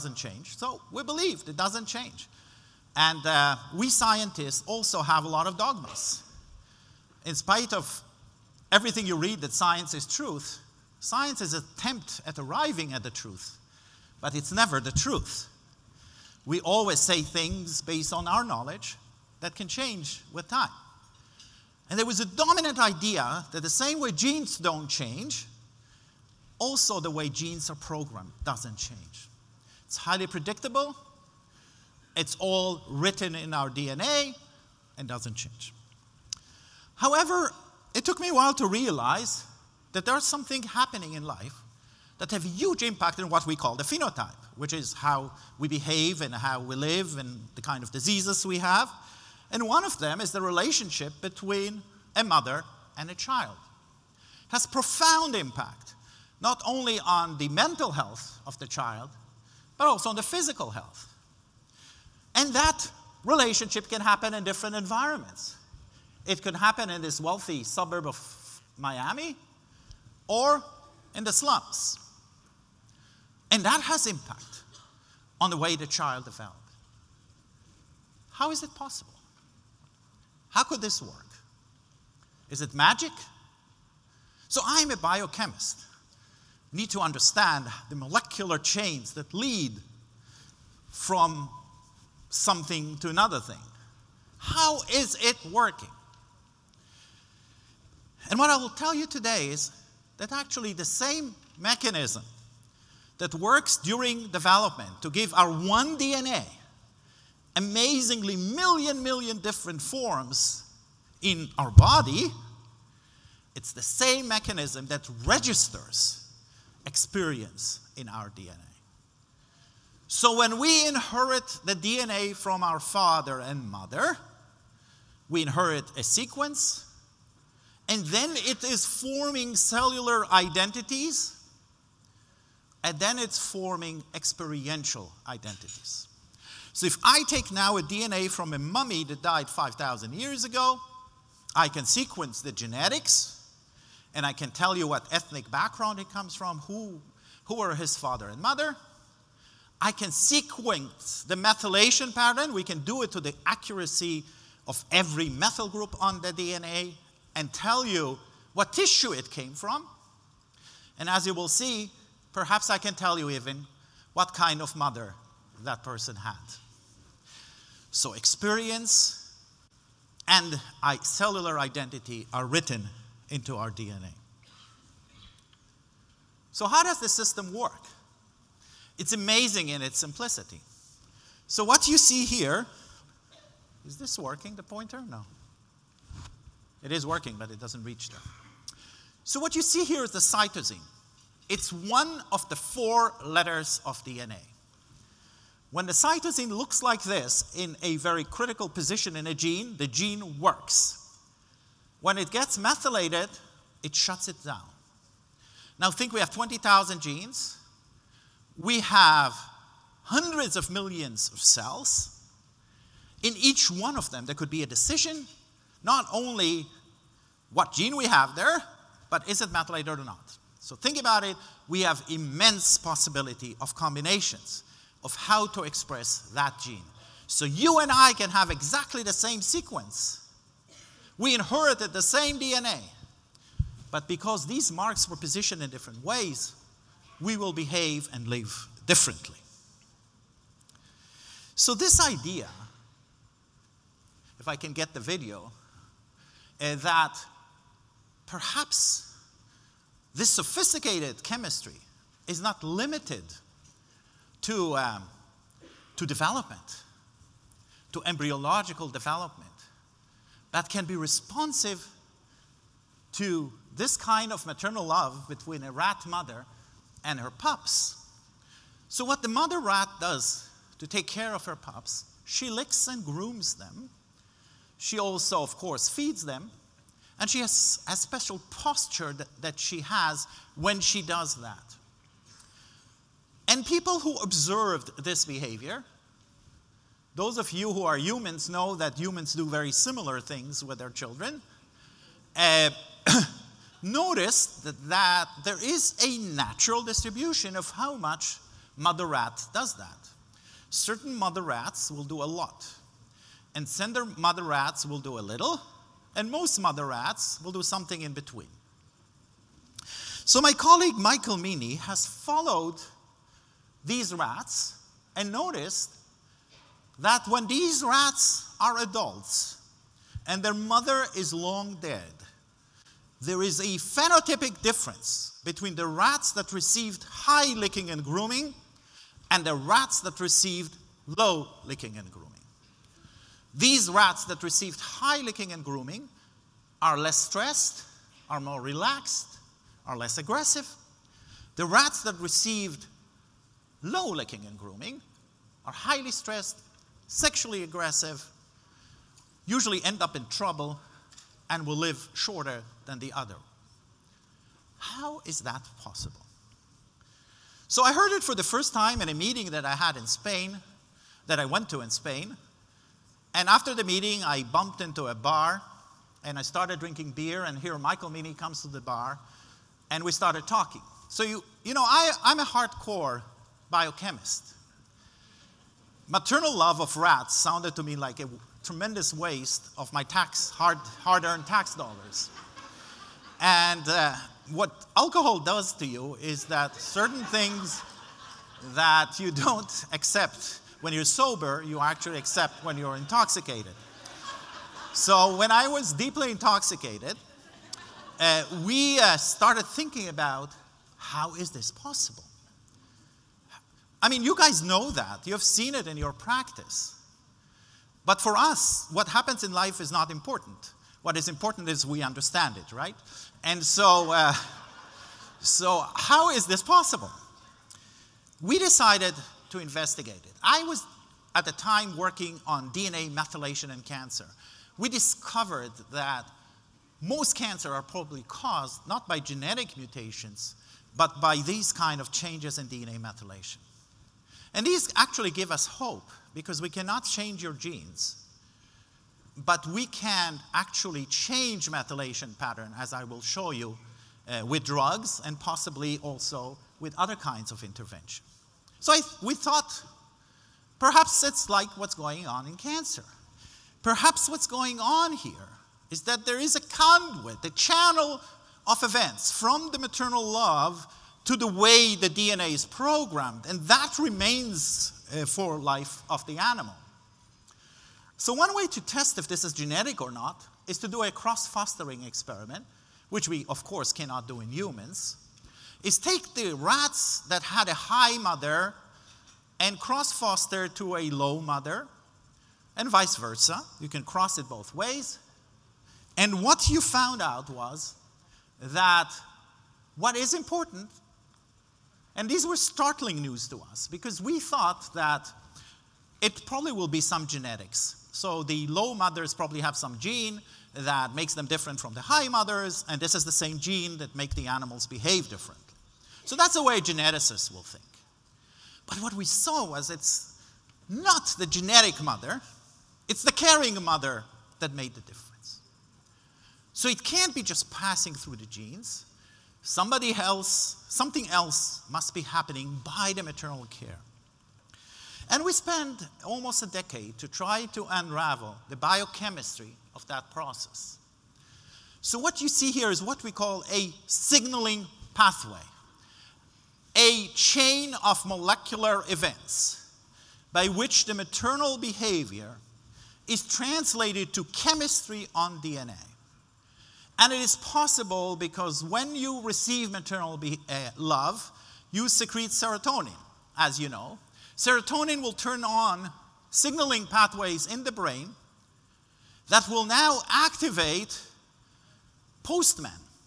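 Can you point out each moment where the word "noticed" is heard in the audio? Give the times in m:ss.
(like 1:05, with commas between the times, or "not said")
4:53, 5:15.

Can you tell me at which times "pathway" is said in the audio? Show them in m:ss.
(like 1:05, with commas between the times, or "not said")
8:55, 9:17.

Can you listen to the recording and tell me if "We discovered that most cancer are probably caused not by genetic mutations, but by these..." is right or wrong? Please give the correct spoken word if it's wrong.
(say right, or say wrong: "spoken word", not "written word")
right.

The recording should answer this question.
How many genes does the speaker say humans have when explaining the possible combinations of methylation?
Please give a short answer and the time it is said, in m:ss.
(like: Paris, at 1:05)
20,000, at 3:26.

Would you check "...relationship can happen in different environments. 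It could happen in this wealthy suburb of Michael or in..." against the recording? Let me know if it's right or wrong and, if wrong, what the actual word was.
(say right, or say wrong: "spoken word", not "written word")
wrong: "Miami", not "Michael".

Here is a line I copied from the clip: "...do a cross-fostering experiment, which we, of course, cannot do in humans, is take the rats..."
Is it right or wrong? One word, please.
right.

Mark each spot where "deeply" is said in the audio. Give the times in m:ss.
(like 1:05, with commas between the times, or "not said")
6:35.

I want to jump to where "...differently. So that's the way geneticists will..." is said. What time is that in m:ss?
8:25.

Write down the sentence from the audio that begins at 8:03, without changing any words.
You can cross it both ways.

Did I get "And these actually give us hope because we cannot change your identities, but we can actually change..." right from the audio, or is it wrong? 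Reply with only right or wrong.
wrong.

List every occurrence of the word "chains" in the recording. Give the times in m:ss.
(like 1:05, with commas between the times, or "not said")
1:28, 8:57.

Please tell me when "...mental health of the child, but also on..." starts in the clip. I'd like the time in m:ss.
0:57.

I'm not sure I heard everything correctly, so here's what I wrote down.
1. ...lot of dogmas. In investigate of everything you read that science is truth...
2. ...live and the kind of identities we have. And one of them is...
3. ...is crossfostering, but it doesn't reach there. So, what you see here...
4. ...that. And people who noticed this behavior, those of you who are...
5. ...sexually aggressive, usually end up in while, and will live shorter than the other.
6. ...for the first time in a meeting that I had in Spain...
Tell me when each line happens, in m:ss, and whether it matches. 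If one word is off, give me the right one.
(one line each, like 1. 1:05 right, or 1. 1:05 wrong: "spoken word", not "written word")
1. 0:05 wrong: "spite", not "investigate"
2. 0:46 wrong: "diseases", not "identities"
3. 3:06 wrong: "working", not "crossfostering"
4. 4:41 wrong: "observed", not "noticed"
5. 5:47 wrong: "trouble", not "while"
6. 5:58 right.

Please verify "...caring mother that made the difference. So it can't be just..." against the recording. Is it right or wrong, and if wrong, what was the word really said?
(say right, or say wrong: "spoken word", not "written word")
right.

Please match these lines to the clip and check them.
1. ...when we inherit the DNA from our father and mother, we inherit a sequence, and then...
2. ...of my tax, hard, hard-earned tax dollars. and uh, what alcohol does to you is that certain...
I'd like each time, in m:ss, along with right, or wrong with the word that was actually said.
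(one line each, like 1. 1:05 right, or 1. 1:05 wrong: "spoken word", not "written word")
1. 2:00 right
2. 6:19 right.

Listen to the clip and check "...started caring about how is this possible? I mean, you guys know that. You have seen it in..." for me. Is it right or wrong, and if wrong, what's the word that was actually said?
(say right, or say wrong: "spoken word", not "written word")
wrong: "thinking", not "caring".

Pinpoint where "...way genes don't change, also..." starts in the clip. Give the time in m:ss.
0:23.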